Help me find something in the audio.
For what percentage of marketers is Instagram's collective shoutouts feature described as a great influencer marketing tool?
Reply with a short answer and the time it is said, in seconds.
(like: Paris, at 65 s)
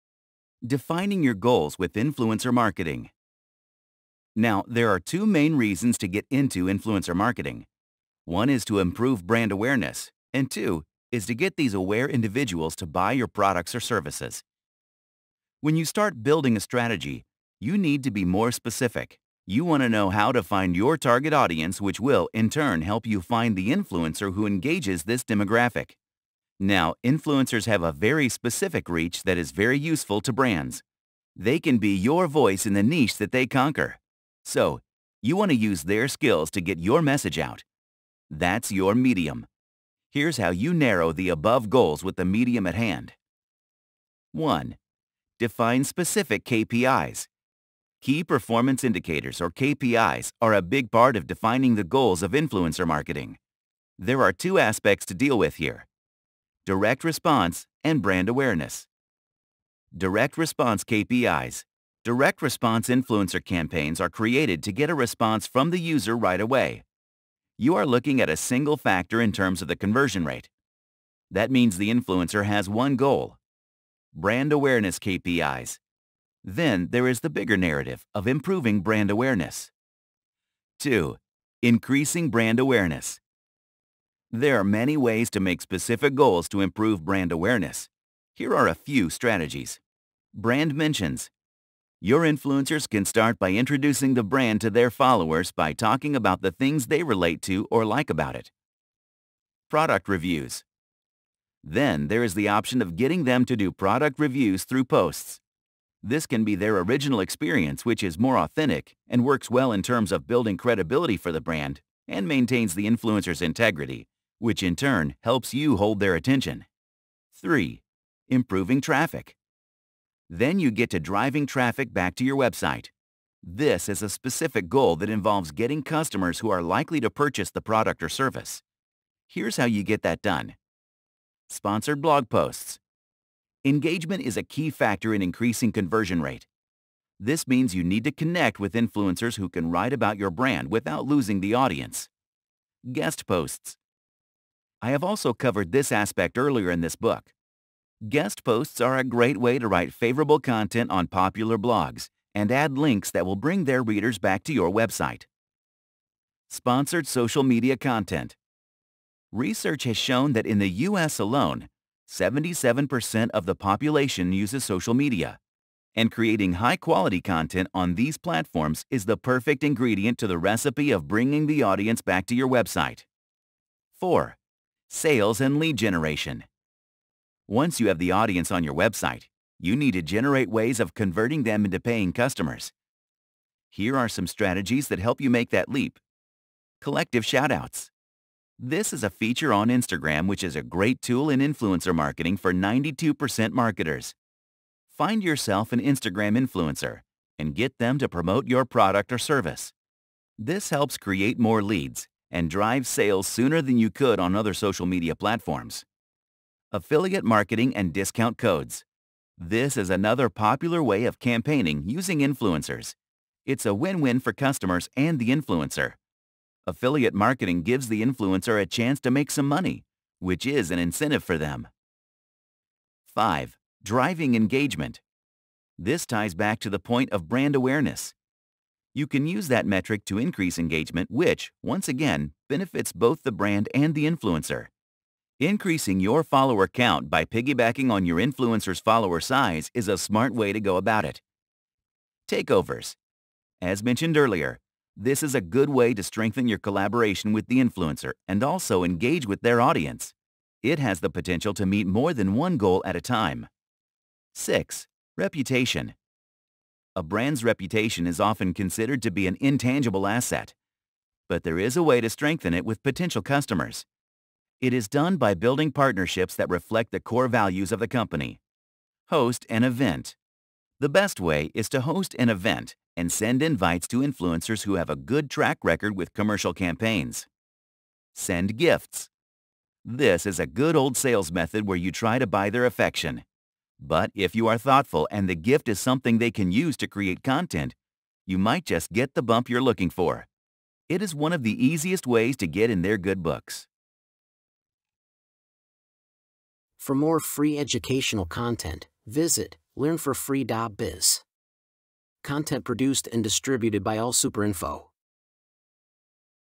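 92%, at 192 s.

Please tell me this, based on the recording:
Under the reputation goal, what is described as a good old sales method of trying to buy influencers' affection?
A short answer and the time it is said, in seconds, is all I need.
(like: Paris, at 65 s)
Send gifts, at 278 s.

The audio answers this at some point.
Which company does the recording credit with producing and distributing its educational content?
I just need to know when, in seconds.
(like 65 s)
303 s.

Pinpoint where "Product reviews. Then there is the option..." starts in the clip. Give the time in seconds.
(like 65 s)
99 s.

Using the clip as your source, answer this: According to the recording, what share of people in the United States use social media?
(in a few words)
77%.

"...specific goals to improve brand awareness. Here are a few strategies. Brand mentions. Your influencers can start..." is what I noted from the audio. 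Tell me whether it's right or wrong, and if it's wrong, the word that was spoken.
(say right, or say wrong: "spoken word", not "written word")
right.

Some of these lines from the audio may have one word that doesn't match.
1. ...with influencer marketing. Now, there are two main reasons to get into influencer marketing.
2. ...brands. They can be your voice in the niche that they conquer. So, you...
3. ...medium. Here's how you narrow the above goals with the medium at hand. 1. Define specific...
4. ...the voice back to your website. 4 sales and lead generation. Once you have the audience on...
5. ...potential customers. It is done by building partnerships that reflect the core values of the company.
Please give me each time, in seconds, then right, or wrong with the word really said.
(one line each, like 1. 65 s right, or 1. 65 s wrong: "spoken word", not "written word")
1. 1 s right
2. 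30 s right
3. 38 s right
4. 171 s wrong: "audience", not "voice"
5. 262 s right.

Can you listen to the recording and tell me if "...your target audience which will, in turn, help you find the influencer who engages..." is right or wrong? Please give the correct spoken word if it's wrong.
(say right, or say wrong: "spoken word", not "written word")
right.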